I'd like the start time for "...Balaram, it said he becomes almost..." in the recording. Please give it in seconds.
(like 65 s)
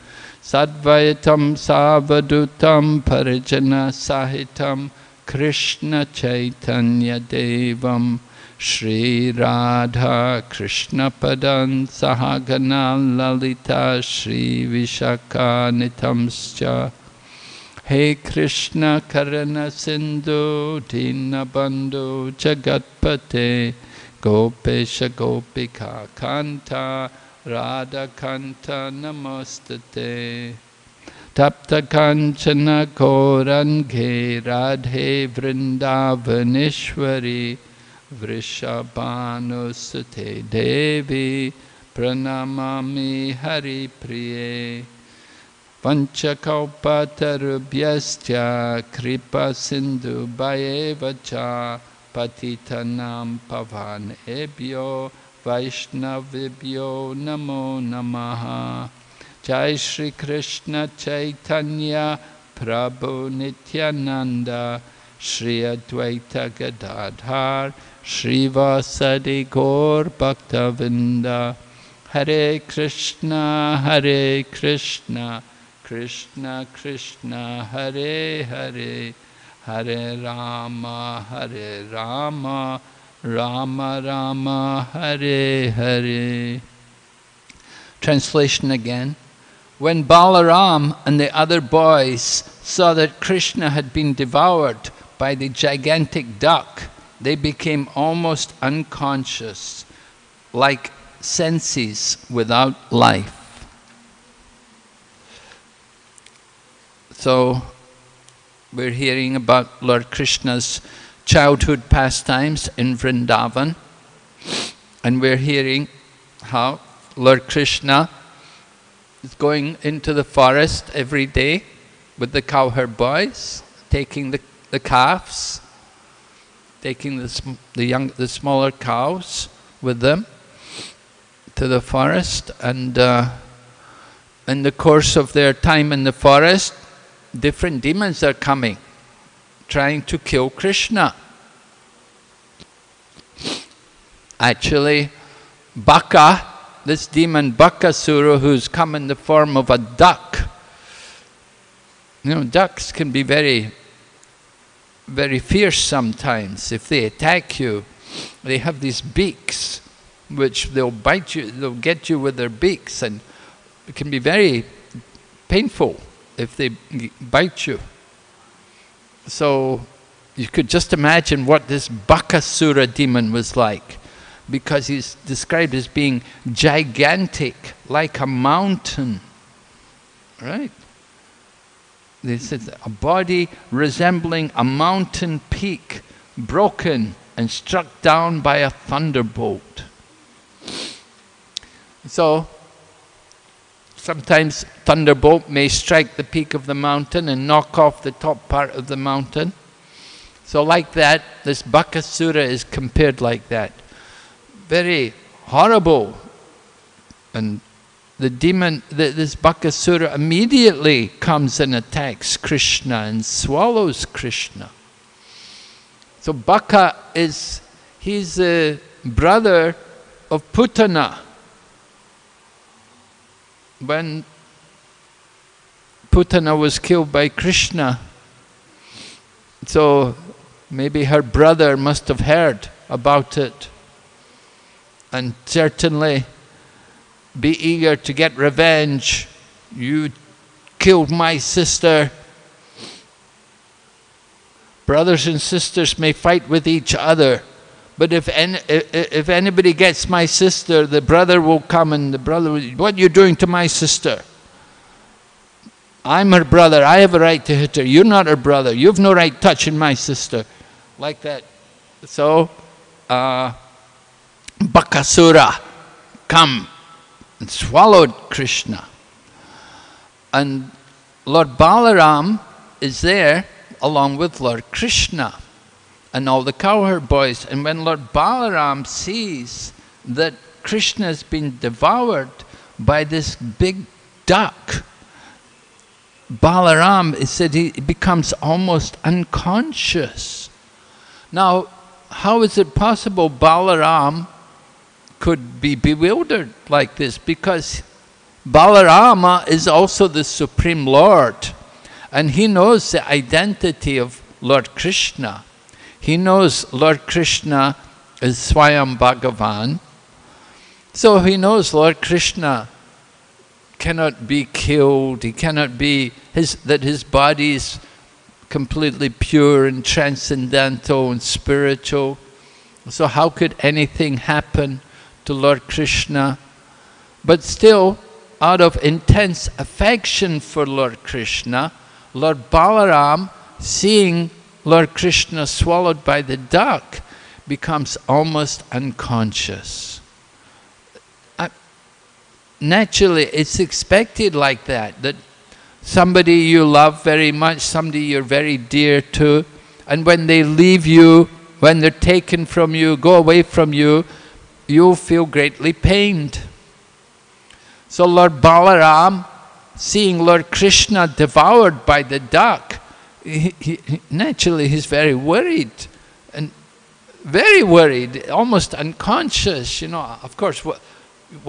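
286 s.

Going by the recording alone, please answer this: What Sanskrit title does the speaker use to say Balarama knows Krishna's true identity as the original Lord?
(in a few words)
Swayam Bhagavan.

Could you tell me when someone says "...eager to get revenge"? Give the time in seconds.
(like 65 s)
237 s.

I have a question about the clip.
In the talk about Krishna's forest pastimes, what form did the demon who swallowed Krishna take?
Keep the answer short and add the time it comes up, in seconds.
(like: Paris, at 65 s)
A duck, at 148 s.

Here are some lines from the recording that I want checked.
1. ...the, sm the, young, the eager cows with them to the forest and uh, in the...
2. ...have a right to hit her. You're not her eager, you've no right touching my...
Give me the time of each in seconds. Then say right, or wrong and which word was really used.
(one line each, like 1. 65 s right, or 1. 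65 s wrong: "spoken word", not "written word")
1. 127 s wrong: "smaller", not "eager"
2. 256 s wrong: "brother", not "eager".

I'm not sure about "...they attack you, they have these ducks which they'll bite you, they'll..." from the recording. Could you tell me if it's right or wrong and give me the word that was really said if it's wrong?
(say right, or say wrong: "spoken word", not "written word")
wrong: "beaks", not "ducks".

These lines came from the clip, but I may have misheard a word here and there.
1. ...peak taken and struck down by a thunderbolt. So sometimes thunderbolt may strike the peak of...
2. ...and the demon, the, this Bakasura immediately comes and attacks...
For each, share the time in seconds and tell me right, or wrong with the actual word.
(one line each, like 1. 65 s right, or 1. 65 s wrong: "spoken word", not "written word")
1. 185 s wrong: "broken", not "taken"
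2. 207 s right.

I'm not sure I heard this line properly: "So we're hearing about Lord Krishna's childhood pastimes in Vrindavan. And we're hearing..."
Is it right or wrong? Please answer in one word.
right.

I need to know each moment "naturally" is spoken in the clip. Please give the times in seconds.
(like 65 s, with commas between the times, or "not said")
342 s, 364 s.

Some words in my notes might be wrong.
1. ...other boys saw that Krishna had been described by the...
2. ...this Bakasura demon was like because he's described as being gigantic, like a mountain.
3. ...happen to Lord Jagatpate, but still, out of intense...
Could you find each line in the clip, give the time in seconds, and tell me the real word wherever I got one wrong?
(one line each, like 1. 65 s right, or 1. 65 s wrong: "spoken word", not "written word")
1. 91 s wrong: "devoured", not "described"
2. 171 s right
3. 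324 s wrong: "Krishna", not "Jagatpate".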